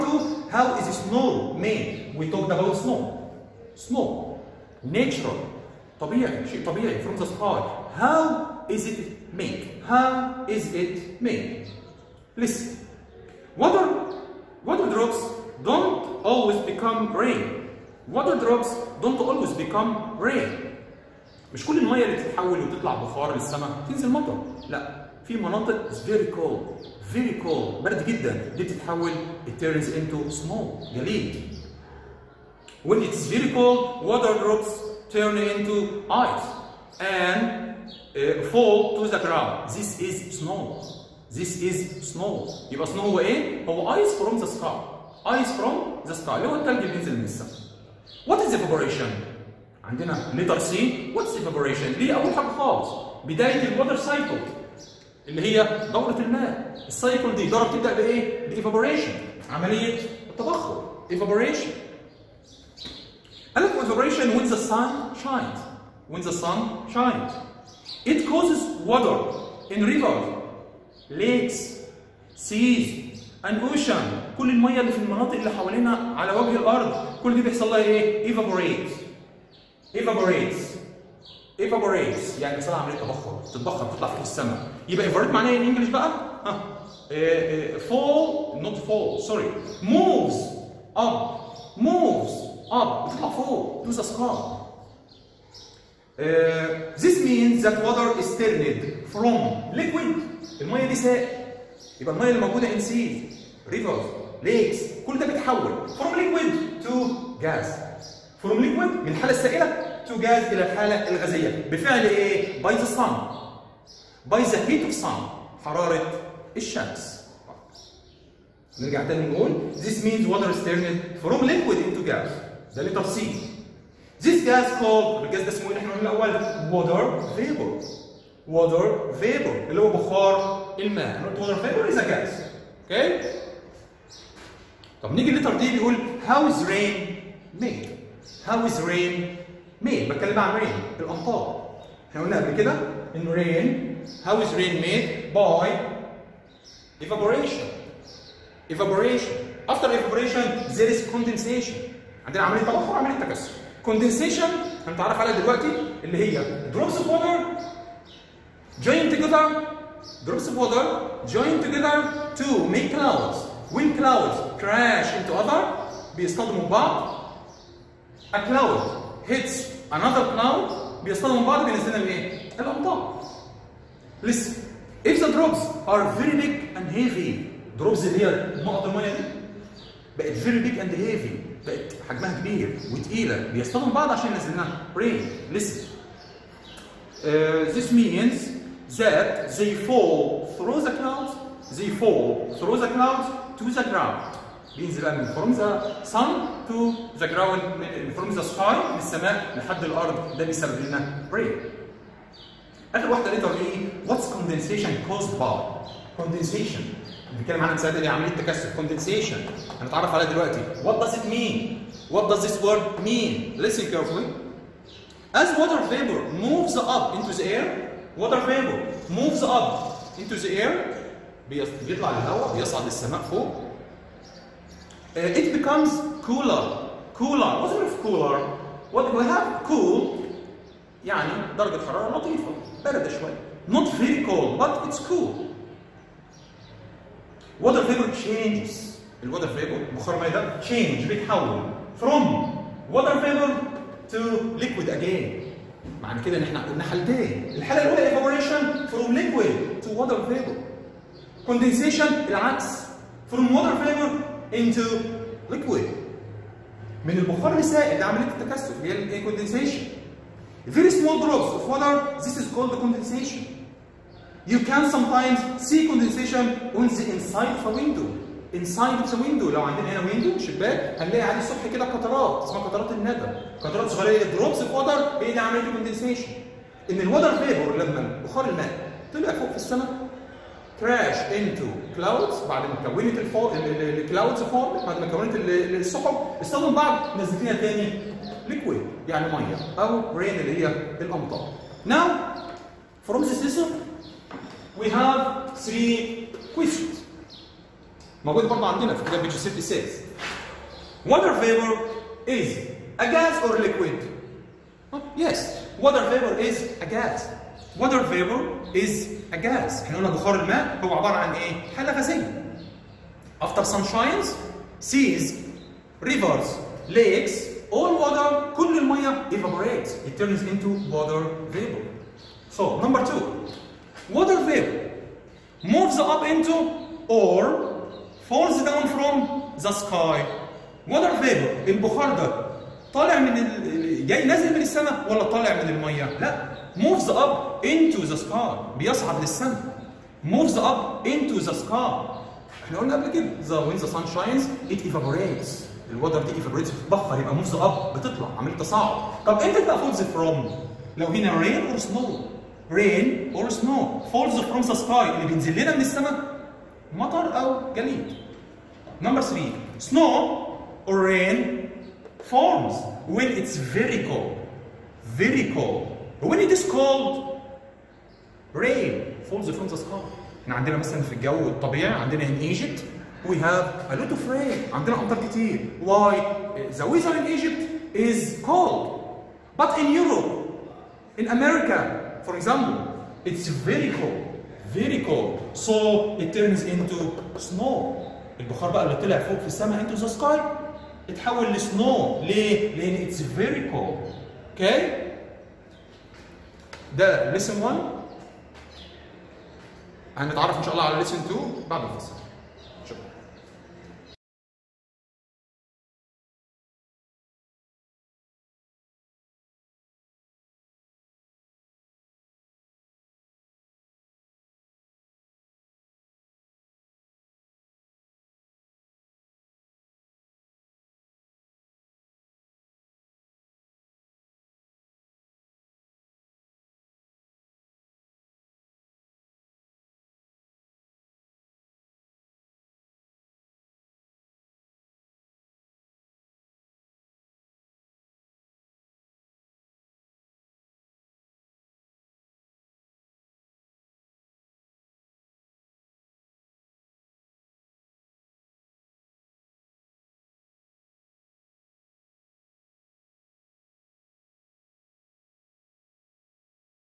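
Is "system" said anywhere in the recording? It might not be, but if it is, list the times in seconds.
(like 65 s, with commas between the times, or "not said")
293 s.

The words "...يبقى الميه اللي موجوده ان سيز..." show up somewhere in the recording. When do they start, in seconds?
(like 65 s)
101 s.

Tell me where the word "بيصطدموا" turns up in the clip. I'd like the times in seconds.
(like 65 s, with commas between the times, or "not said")
166 s, 171 s, 183 s.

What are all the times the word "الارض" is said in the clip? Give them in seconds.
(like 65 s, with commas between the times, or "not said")
76 s, 199 s.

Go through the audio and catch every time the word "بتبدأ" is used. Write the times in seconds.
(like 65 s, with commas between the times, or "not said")
57 s.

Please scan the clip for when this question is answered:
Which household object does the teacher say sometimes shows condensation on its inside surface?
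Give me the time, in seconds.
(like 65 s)
267 s.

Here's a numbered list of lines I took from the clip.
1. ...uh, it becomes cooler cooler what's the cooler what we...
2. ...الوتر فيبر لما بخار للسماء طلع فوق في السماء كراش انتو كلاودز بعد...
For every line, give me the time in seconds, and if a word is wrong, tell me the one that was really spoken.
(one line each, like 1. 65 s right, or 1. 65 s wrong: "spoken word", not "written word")
1. 225 s right
2. 276 s wrong: "الماء", not "للسماء".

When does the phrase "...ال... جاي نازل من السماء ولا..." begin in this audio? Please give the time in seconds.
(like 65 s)
333 s.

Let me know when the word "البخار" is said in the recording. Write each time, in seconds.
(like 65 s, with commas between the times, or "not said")
257 s, 331 s, 388 s.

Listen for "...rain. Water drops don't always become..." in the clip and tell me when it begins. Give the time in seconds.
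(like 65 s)
17 s.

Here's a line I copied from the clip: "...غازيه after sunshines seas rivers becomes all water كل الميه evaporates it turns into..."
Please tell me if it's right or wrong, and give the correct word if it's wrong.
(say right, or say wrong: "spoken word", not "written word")
wrong: "lakes", not "becomes".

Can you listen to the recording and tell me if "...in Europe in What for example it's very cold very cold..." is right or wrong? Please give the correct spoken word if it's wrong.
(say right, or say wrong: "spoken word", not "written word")
wrong: "America", not "What".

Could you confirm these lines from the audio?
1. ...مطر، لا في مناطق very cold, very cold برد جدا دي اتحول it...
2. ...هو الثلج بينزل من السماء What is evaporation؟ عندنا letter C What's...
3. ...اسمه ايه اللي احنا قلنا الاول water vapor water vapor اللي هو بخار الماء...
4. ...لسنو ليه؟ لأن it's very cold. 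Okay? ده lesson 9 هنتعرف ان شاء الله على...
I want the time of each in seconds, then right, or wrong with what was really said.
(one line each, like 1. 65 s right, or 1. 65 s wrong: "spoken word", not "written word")
1. 24 s wrong: "تتحول", not "اتحول"
2. 46 s right
3. 125 s right
4. 391 s wrong: "1", not "9".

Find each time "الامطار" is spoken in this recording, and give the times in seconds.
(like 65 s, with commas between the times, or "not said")
140 s, 290 s.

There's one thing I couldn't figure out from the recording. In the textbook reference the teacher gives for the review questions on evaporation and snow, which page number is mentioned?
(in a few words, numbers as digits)
66.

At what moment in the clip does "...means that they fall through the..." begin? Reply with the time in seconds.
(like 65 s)
187 s.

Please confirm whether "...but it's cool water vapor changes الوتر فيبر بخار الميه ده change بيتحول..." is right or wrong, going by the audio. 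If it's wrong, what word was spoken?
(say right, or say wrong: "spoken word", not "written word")
right.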